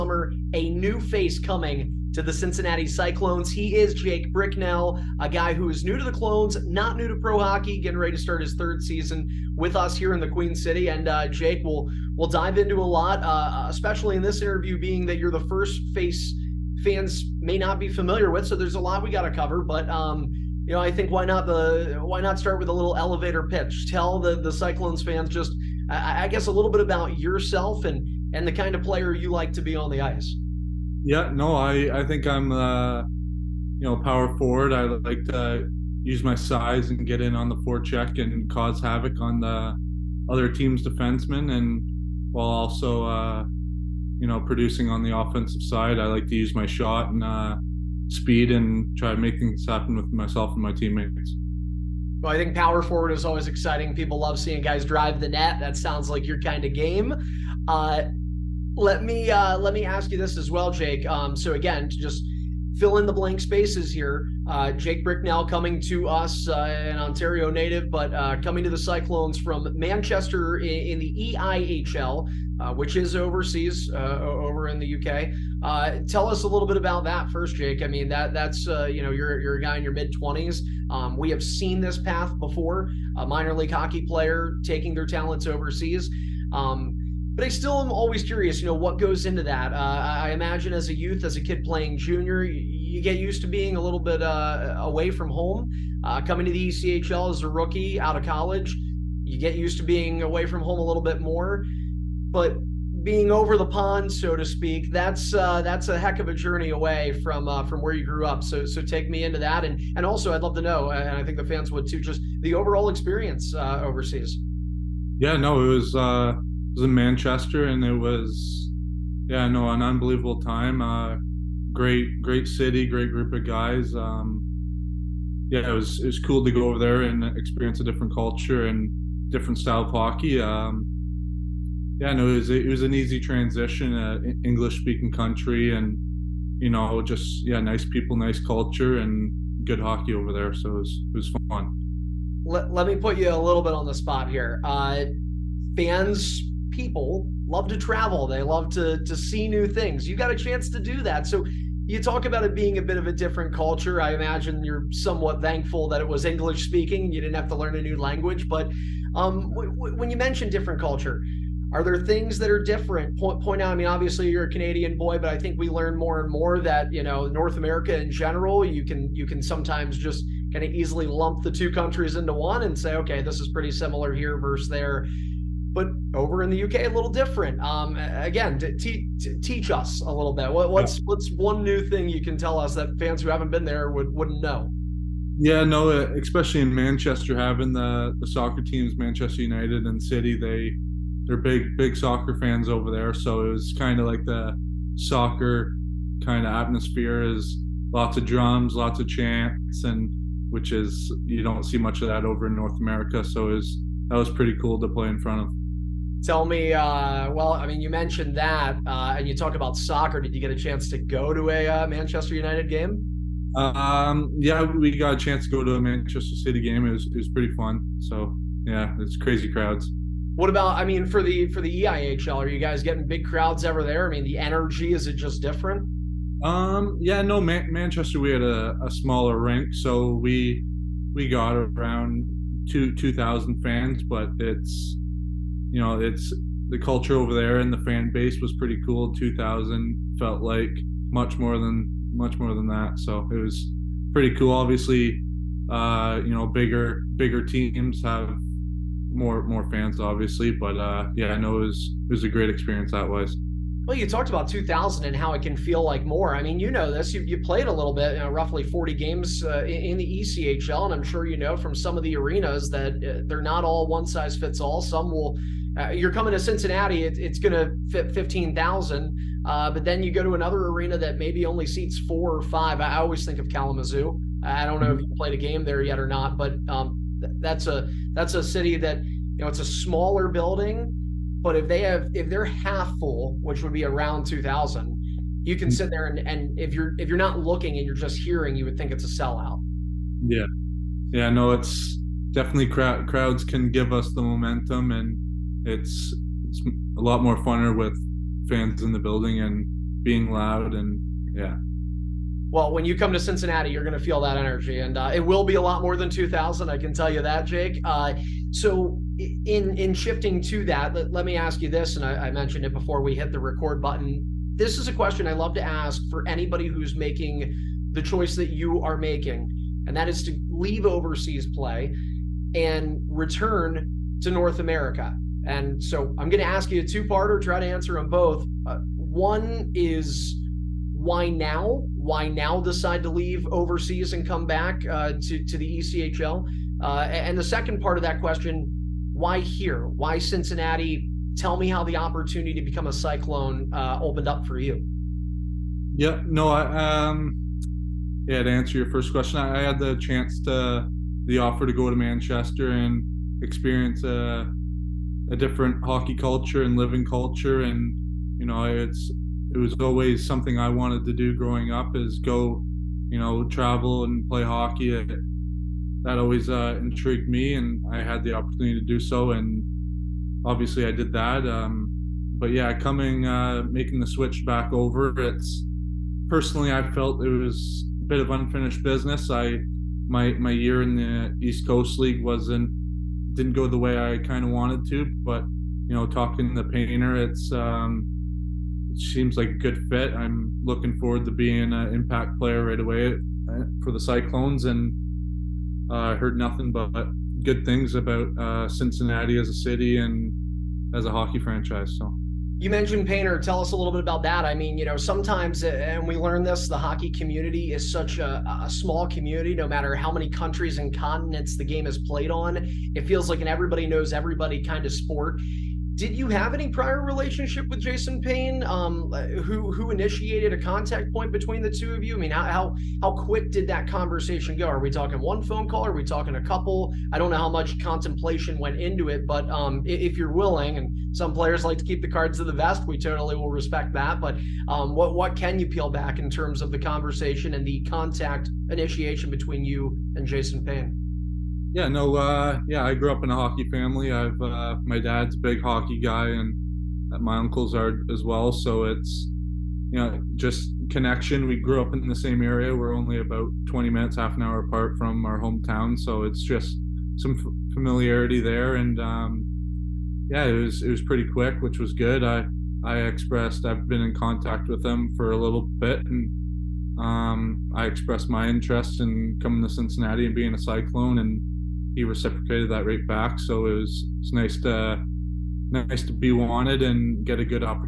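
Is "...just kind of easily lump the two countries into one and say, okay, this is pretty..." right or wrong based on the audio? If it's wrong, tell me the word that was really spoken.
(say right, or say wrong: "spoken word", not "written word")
right.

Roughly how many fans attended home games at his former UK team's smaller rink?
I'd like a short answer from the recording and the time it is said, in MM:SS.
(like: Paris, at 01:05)
2,000, at 03:52.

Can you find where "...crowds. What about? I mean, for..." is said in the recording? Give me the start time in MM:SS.
03:39.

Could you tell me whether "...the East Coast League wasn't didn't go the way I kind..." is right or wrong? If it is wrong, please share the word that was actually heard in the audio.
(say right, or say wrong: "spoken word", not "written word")
right.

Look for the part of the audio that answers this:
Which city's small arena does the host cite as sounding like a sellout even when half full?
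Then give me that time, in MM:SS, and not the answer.
04:33.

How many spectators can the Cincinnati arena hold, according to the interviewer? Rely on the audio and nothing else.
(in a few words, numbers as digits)
15,000.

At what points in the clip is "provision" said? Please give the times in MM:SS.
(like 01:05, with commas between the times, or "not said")
not said.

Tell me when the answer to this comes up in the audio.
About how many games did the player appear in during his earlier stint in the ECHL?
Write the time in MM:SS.
04:18.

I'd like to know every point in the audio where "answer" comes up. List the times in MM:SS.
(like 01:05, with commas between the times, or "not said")
05:27, 05:48.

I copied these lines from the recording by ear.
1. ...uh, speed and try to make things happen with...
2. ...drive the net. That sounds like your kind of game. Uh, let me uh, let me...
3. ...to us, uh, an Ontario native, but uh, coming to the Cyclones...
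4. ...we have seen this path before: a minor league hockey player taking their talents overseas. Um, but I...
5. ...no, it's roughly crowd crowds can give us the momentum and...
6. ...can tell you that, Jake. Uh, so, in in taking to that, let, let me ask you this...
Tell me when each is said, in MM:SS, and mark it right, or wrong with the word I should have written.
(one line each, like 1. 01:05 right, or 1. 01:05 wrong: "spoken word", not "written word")
1. 00:47 right
2. 00:54 right
3. 01:05 right
4. 01:21 right
5. 04:51 wrong: "definitely", not "roughly"
6. 05:06 wrong: "shifting", not "taking".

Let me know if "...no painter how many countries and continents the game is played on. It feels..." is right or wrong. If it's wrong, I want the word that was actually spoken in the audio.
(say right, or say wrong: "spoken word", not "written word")
wrong: "matter", not "painter".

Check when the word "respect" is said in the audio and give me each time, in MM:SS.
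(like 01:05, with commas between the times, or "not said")
07:13.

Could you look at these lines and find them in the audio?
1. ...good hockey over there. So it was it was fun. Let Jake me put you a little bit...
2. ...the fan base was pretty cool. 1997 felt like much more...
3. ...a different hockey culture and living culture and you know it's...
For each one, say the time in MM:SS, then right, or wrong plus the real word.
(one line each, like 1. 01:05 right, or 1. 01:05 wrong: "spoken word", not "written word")
1. 02:19 wrong: "Let", not "Jake"
2. 03:57 wrong: "2000", not "1997"
3. 05:55 right.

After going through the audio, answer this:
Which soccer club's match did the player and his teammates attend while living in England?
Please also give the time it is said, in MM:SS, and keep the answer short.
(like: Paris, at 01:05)
Manchester City, at 03:35.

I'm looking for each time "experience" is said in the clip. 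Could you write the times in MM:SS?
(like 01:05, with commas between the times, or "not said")
01:52, 02:07, 04:12, 05:53.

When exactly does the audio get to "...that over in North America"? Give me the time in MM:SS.
03:22.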